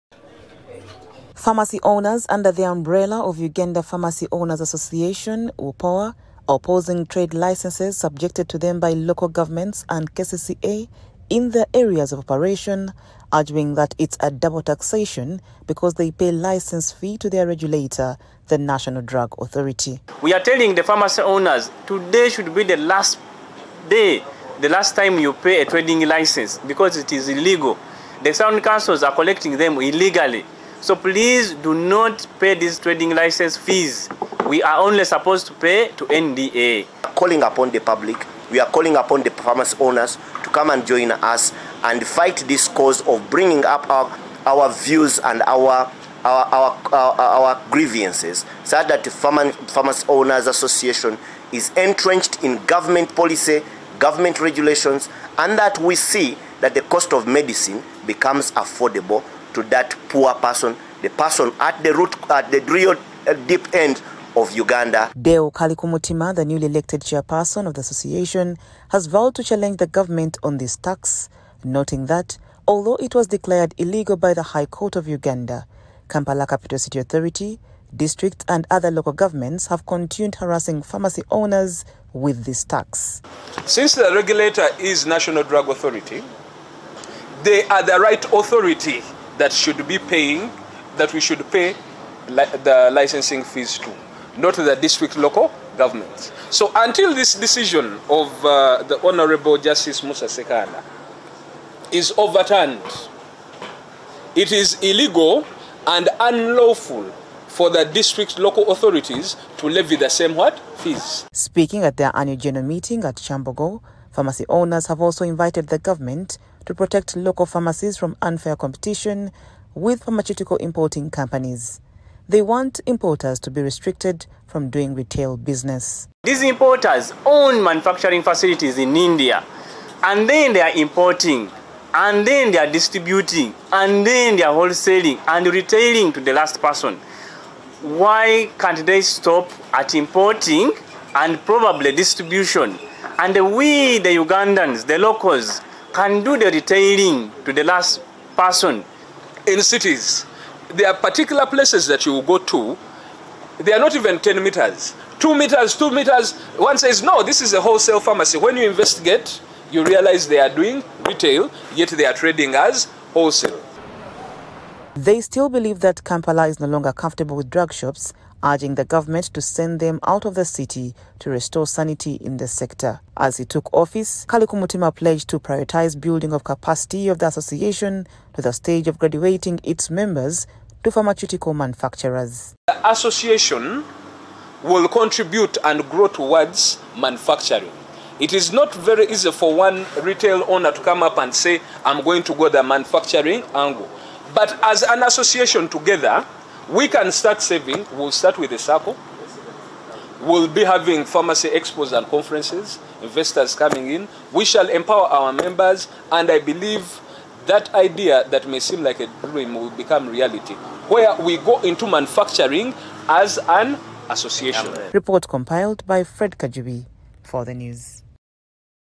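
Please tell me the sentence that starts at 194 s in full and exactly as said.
But as an association together, we can start saving.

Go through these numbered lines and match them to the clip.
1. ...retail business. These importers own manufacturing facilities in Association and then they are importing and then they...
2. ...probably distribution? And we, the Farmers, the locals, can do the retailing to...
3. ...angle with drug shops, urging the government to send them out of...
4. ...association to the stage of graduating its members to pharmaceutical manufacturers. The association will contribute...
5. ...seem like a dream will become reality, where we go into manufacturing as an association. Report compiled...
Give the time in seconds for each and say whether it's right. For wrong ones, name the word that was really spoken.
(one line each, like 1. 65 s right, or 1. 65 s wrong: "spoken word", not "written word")
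1. 124 s wrong: "India", not "Association"
2. 141 s wrong: "Ugandans", not "Farmers"
3. 166 s wrong: "comfortable", not "angle"
4. 177 s right
5. 208 s right.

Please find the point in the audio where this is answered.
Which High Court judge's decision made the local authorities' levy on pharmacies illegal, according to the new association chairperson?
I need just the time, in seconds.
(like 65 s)
100 s.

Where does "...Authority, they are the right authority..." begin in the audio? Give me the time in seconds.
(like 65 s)
85 s.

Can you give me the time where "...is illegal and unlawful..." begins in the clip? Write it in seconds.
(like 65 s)
104 s.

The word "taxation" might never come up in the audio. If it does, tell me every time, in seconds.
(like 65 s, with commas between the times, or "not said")
14 s.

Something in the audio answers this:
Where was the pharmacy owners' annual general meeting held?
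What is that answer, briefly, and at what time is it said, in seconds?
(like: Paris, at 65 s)
Kyambogo, at 113 s.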